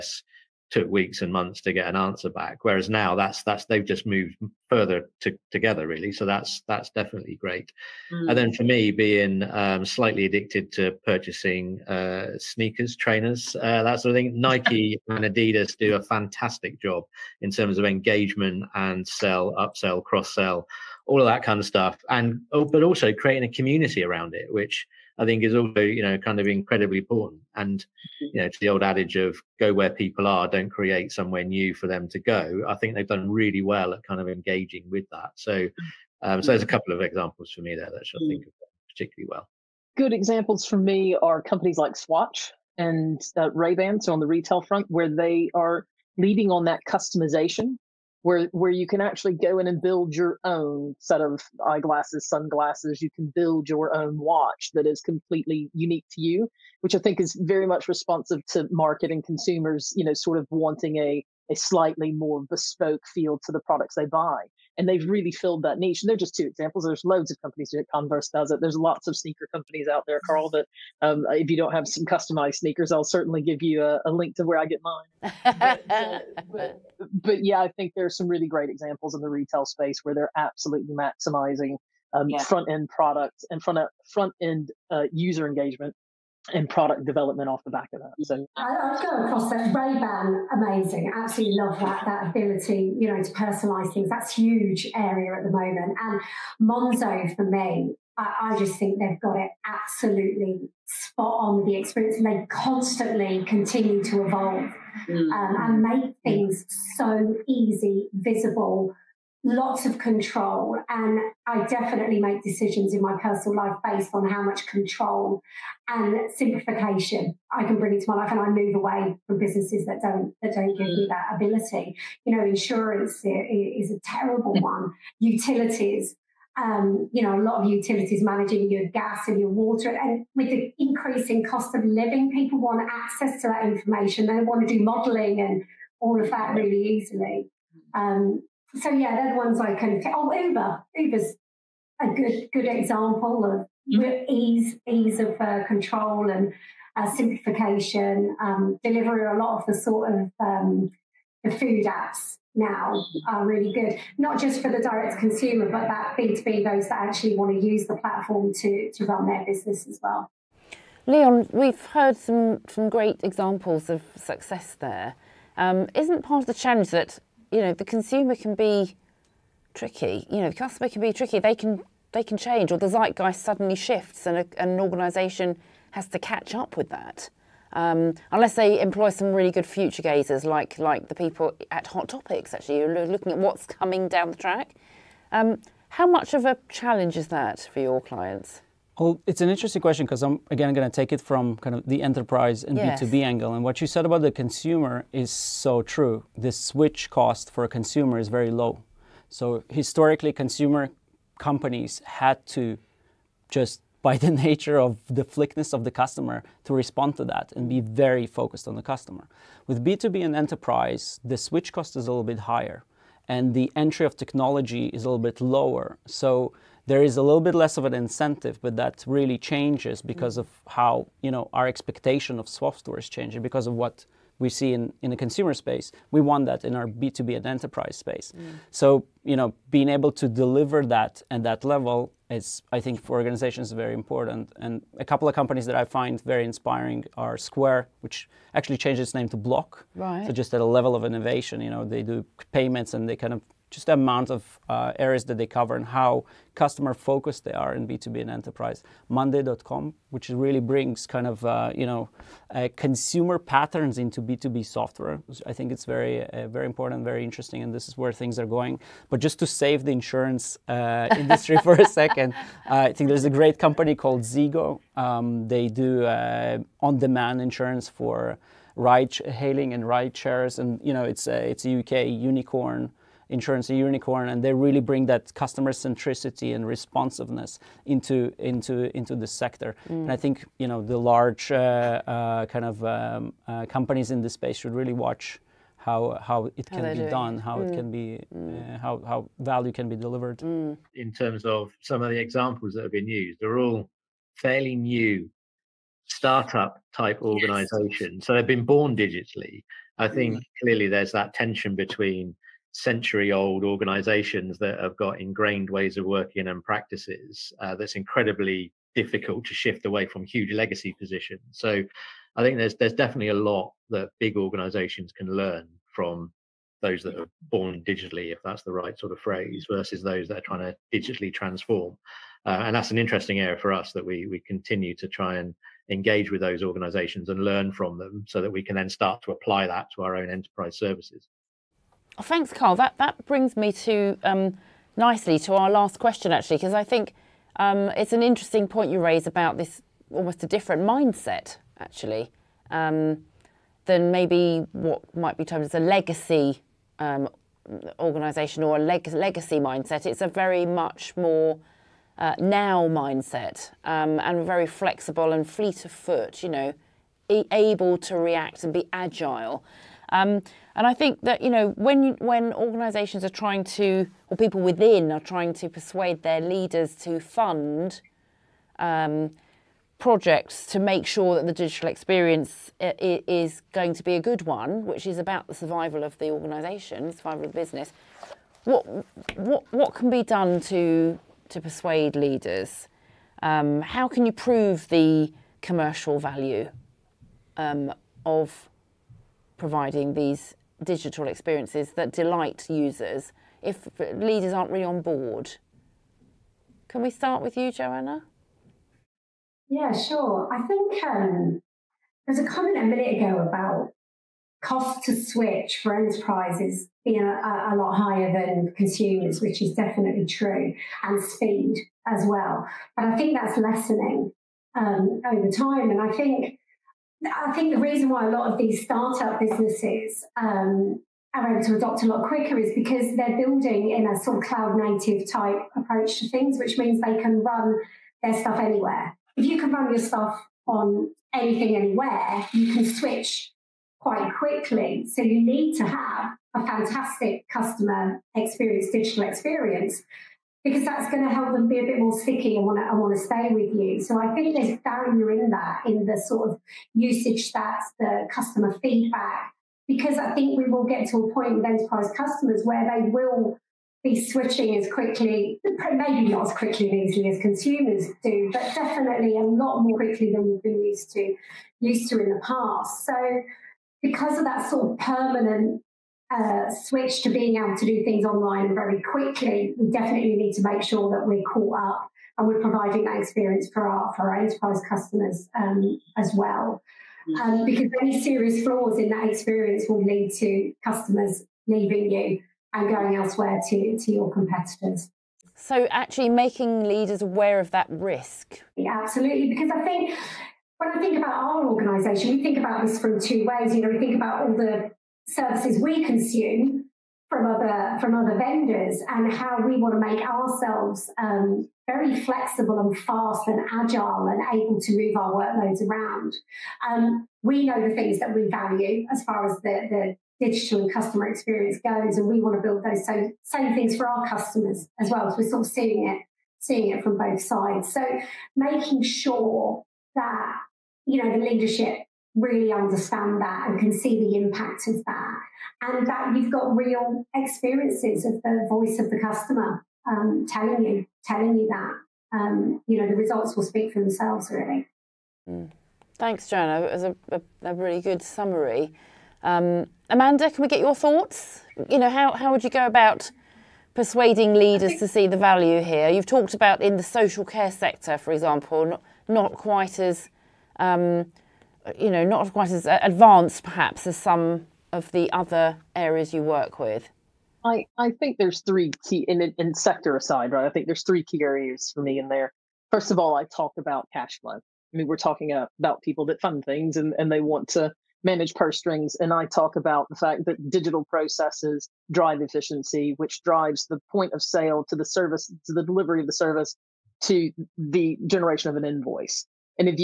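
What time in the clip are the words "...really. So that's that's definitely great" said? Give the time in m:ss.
0:05.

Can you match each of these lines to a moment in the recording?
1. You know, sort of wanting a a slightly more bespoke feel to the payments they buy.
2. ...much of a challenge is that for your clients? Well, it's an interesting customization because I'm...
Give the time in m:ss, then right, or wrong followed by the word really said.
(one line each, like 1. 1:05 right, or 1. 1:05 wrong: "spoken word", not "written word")
1. 0:59 wrong: "products", not "payments"
2. 3:06 wrong: "question", not "customization".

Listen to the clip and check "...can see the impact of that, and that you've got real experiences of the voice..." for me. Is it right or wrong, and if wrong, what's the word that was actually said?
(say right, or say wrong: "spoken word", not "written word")
right.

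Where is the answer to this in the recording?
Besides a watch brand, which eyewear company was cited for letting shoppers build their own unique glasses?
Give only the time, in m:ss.
0:43.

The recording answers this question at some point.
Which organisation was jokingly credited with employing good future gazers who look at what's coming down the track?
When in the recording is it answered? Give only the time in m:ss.
3:01.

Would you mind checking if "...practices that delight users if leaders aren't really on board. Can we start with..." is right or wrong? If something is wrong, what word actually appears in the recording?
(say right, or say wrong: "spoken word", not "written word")
wrong: "experiences", not "practices".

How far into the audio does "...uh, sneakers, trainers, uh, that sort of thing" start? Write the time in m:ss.
0:11.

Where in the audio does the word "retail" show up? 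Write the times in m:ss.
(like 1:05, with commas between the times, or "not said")
0:44, 1:19.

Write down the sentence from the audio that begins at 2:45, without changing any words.
Um, not part of the challenge that you know, the consumer can be tricky.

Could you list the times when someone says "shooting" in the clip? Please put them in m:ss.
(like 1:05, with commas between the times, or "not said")
not said.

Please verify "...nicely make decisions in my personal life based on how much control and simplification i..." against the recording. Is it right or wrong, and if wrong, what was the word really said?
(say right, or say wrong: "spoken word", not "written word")
wrong: "definitely", not "nicely".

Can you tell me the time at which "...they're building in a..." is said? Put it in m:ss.
7:03.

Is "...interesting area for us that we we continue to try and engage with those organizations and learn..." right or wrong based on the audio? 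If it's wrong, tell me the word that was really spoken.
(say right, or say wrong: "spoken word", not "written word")
right.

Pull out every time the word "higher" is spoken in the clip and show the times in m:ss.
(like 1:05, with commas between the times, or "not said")
3:32, 6:47.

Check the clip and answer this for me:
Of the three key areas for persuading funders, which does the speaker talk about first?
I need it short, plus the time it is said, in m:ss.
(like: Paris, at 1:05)
Cash flow, at 9:24.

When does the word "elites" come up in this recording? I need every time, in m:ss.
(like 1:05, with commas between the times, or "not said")
not said.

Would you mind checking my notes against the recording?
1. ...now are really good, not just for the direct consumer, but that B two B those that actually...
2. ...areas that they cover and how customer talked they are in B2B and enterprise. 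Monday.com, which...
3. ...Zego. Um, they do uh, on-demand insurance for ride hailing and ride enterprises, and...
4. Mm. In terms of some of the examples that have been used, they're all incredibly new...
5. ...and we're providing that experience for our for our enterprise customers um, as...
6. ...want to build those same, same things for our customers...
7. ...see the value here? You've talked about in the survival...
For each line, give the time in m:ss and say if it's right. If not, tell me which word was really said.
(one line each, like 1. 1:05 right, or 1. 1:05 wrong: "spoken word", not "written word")
1. 2:32 right
2. 4:04 wrong: "focused", not "talked"
3. 4:24 wrong: "shares", not "enterprises"
4. 4:50 wrong: "fairly", not "incredibly"
5. 7:52 right
6. 8:32 right
7. 9:05 wrong: "social", not "survival".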